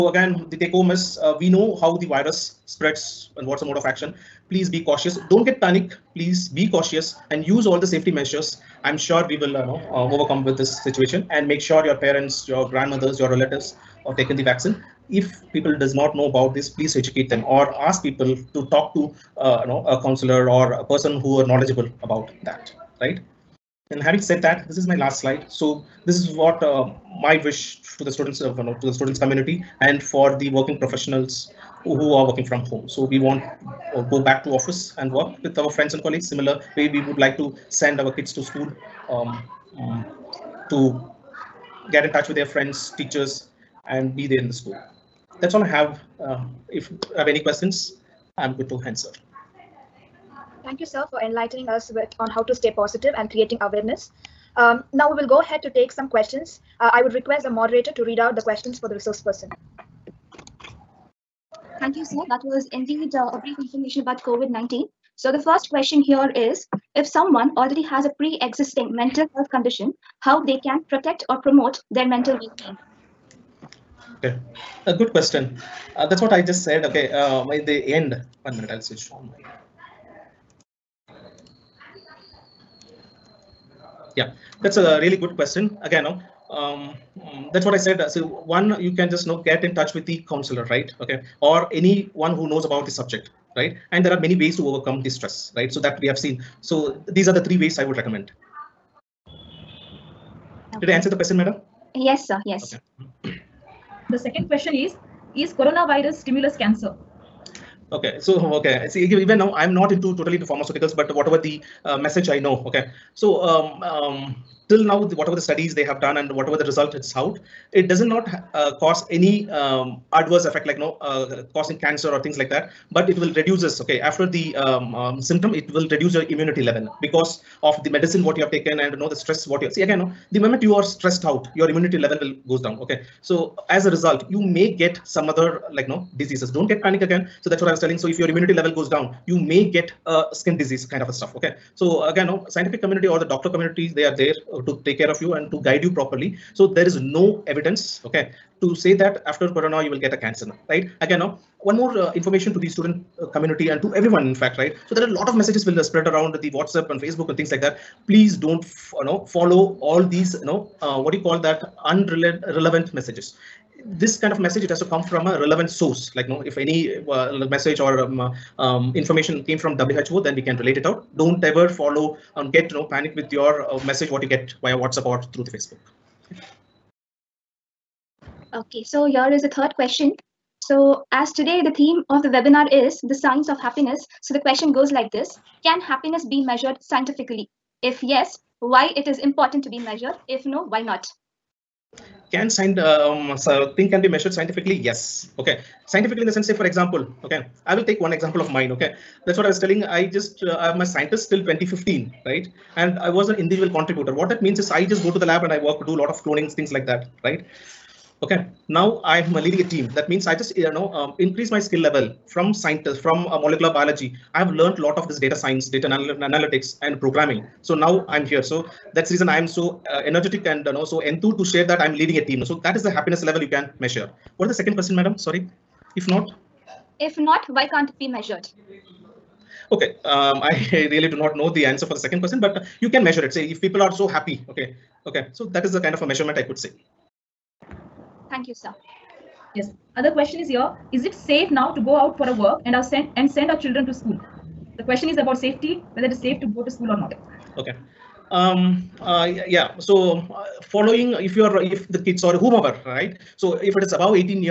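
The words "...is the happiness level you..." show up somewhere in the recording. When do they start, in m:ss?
3:42.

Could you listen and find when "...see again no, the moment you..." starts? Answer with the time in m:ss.
2:09.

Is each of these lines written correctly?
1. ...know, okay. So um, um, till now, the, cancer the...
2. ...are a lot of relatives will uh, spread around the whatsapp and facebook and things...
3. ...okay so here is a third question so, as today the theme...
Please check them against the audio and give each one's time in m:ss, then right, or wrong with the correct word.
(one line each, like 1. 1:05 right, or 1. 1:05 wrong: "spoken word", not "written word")
1. 1:52 wrong: "whatever", not "cancer"
2. 2:35 wrong: "messages", not "relatives"
3. 2:58 right.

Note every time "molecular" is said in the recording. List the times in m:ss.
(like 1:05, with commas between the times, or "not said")
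3:33.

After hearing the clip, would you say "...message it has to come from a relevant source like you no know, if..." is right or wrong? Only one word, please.
right.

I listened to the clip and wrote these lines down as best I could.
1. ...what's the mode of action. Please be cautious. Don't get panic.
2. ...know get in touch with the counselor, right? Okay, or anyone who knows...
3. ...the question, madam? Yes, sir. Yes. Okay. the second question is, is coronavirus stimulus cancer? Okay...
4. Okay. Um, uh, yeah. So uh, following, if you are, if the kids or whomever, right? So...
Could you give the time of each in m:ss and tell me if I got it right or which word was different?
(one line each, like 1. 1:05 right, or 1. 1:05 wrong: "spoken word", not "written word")
1. 0:03 right
2. 1:29 right
3. 1:41 right
4. 4:07 right.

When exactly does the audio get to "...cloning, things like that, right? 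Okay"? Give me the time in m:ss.
3:26.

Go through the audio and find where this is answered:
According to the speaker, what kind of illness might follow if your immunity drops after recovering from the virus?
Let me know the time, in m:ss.
2:20.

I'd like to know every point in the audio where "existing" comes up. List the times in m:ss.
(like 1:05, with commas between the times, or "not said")
1:08.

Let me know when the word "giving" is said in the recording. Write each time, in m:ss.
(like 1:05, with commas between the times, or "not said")
not said.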